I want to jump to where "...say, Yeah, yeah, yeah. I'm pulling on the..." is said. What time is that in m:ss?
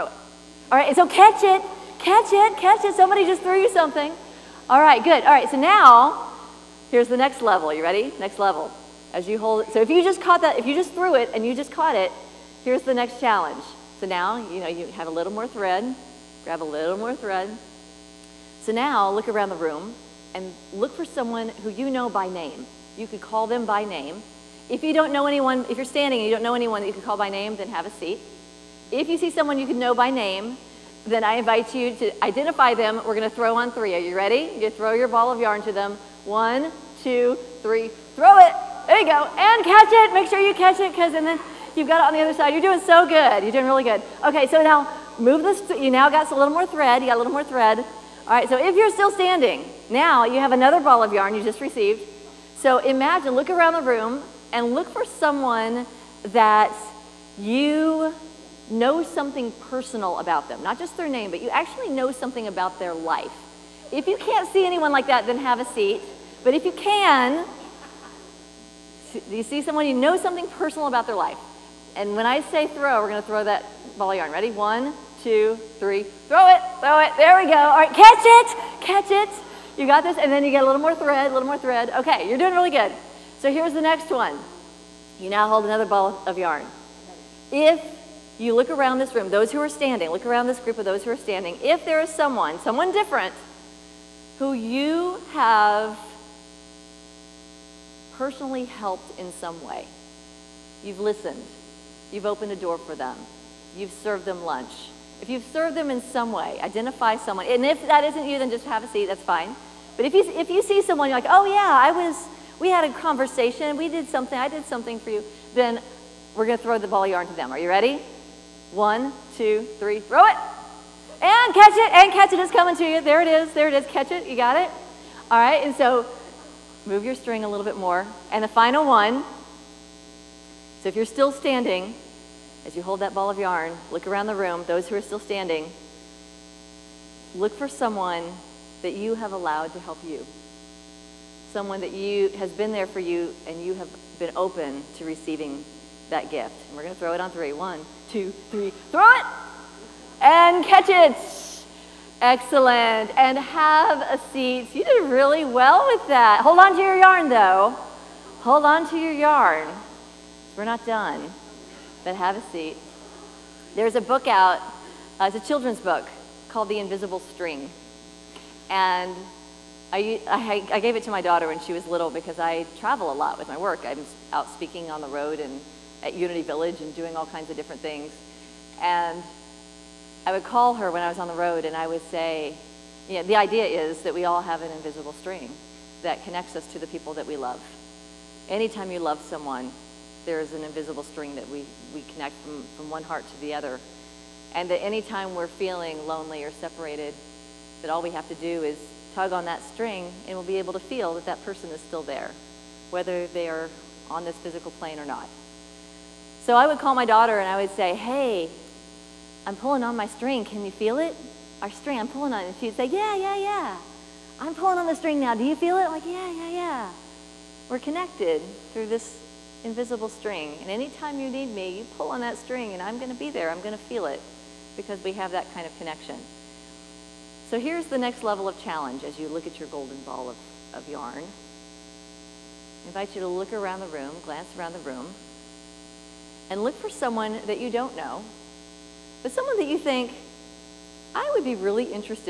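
3:32.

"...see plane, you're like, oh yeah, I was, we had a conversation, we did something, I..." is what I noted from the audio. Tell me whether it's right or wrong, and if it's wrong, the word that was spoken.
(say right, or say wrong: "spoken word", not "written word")
wrong: "someone", not "plane".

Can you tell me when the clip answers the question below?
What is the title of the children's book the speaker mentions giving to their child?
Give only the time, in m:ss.
2:46.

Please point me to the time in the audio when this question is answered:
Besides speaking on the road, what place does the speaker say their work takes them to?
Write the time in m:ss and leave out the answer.
2:56.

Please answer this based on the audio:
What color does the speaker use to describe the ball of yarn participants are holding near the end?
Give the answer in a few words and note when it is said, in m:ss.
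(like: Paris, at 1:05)
golden, at 3:49.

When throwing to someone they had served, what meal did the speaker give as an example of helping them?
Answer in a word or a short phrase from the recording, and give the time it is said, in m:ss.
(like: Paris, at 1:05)
lunch, at 1:44.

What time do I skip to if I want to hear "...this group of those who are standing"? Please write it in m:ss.
1:30.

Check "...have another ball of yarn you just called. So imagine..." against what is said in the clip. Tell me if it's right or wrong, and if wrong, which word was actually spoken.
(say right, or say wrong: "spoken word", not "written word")
wrong: "received", not "called".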